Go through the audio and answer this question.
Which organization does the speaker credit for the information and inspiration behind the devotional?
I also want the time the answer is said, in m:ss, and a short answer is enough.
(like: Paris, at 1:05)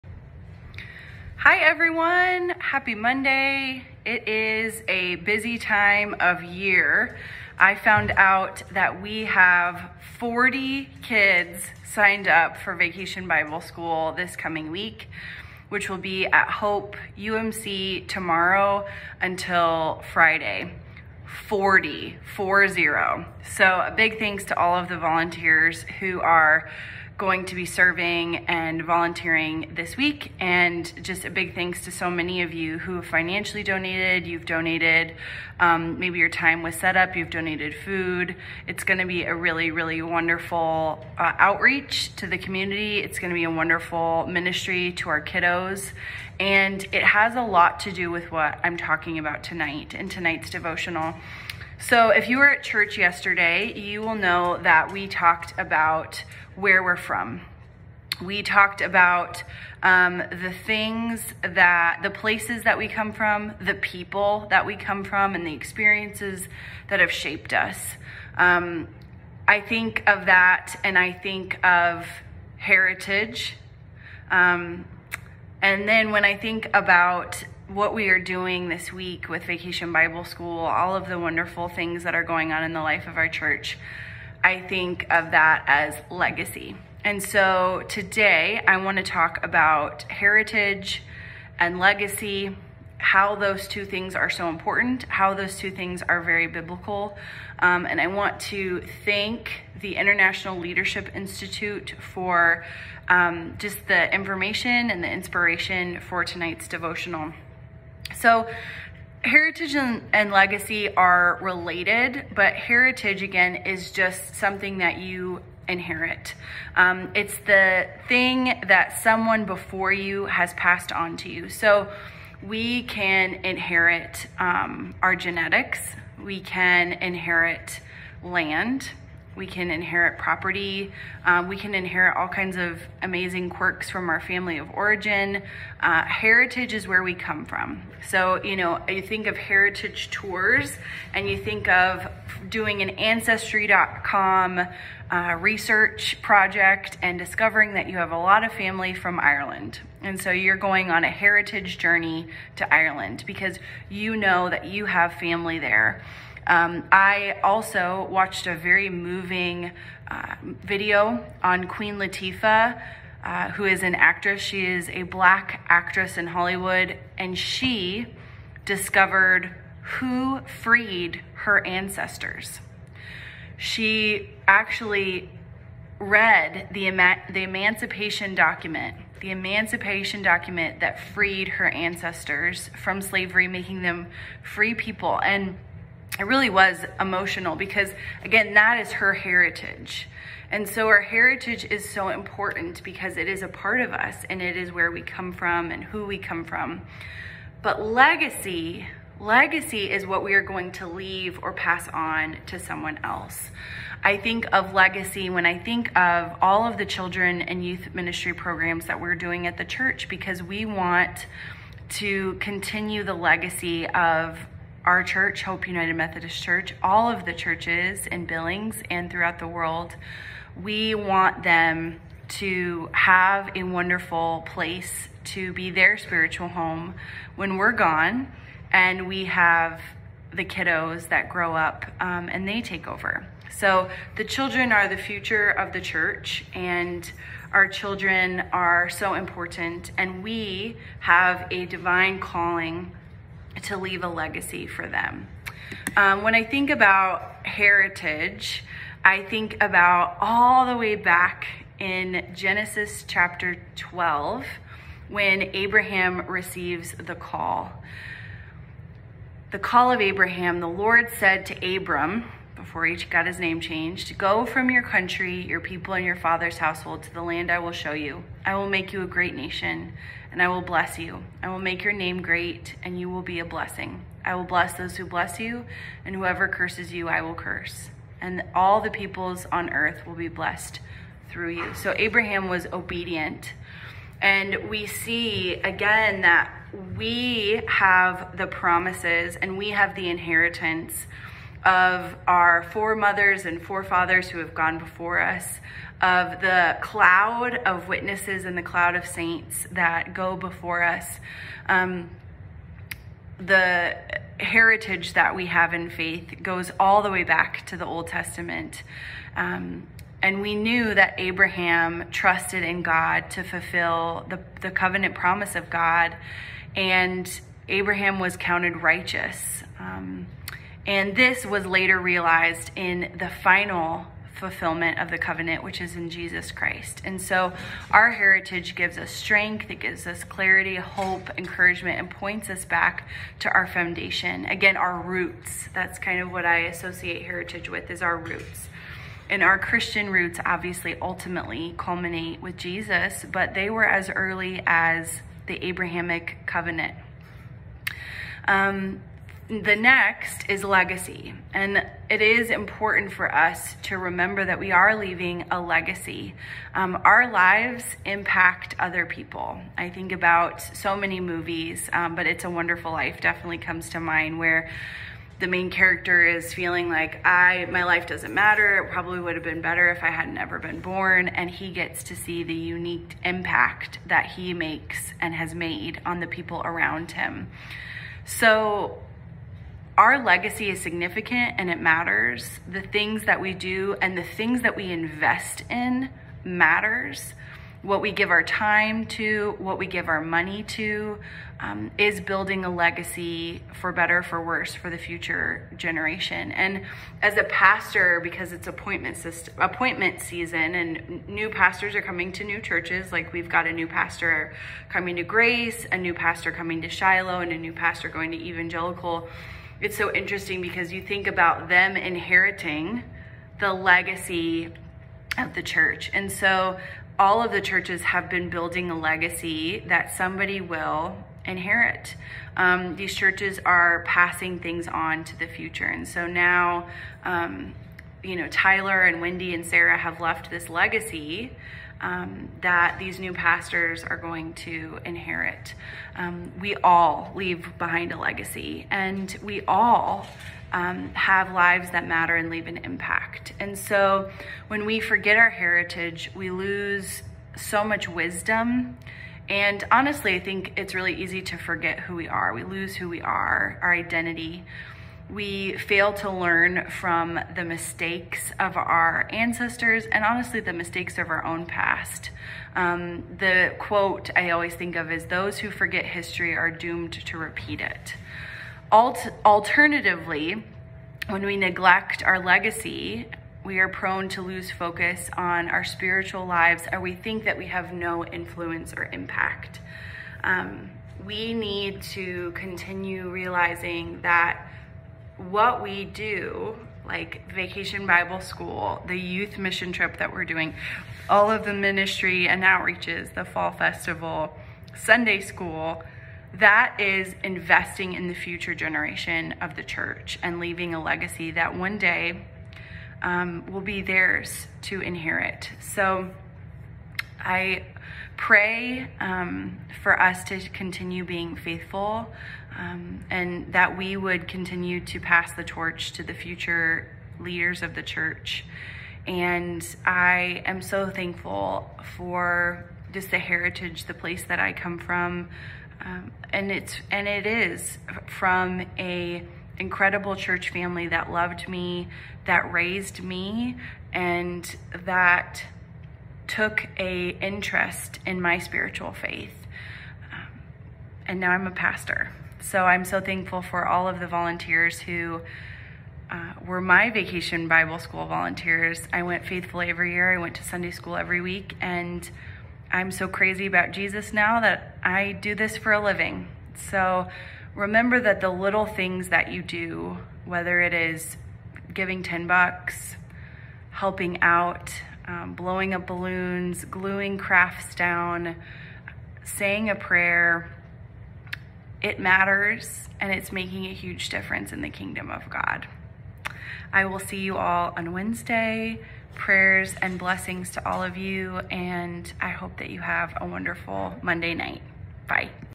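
International Leadership Institute, at 1:39.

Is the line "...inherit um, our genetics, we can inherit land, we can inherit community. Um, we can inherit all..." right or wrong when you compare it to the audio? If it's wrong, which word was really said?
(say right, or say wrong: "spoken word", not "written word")
wrong: "property", not "community".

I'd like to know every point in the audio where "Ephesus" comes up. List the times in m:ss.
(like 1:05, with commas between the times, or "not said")
not said.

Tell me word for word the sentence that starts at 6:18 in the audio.
So our legacy is significant and it matters.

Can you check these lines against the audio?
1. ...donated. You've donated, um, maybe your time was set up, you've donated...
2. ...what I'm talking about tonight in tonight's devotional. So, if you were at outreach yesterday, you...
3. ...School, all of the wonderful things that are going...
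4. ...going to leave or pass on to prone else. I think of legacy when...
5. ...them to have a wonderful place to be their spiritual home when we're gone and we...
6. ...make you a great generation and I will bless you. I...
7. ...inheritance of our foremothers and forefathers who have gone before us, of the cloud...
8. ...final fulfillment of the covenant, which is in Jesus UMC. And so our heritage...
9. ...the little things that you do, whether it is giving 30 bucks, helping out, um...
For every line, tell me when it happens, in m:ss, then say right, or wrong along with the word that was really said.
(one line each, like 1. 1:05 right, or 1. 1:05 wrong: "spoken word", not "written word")
1. 0:33 right
2. 0:48 wrong: "church", not "outreach"
3. 1:20 right
4. 3:20 wrong: "someone", not "prone"
5. 3:41 right
6. 4:28 wrong: "nation", not "generation"
7. 4:50 right
8. 5:23 wrong: "Christ", not "UMC"
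9. 9:18 wrong: "10", not "30".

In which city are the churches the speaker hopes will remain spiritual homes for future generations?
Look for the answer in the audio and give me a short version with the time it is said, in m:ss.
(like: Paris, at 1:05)
Billings, at 3:38.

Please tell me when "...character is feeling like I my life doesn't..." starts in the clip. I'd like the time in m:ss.
6:05.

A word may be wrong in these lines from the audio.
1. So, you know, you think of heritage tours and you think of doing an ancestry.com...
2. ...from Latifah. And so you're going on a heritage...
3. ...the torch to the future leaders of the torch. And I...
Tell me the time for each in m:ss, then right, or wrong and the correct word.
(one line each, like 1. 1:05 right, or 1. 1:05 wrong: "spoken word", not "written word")
1. 2:18 right
2. 2:28 wrong: "Ireland", not "Latifah"
3. 8:35 wrong: "church", not "torch".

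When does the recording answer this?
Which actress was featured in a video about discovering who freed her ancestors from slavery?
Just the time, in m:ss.
2:41.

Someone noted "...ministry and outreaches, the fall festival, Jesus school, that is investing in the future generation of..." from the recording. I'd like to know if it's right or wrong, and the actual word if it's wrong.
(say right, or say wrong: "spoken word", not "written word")
wrong: "Sunday", not "Jesus".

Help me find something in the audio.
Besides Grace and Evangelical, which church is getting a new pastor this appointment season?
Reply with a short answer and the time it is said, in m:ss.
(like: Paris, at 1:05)
Shiloh, at 6:46.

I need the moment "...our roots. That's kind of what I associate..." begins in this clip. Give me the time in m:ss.
5:34.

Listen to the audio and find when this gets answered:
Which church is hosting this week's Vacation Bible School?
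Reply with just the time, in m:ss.
0:16.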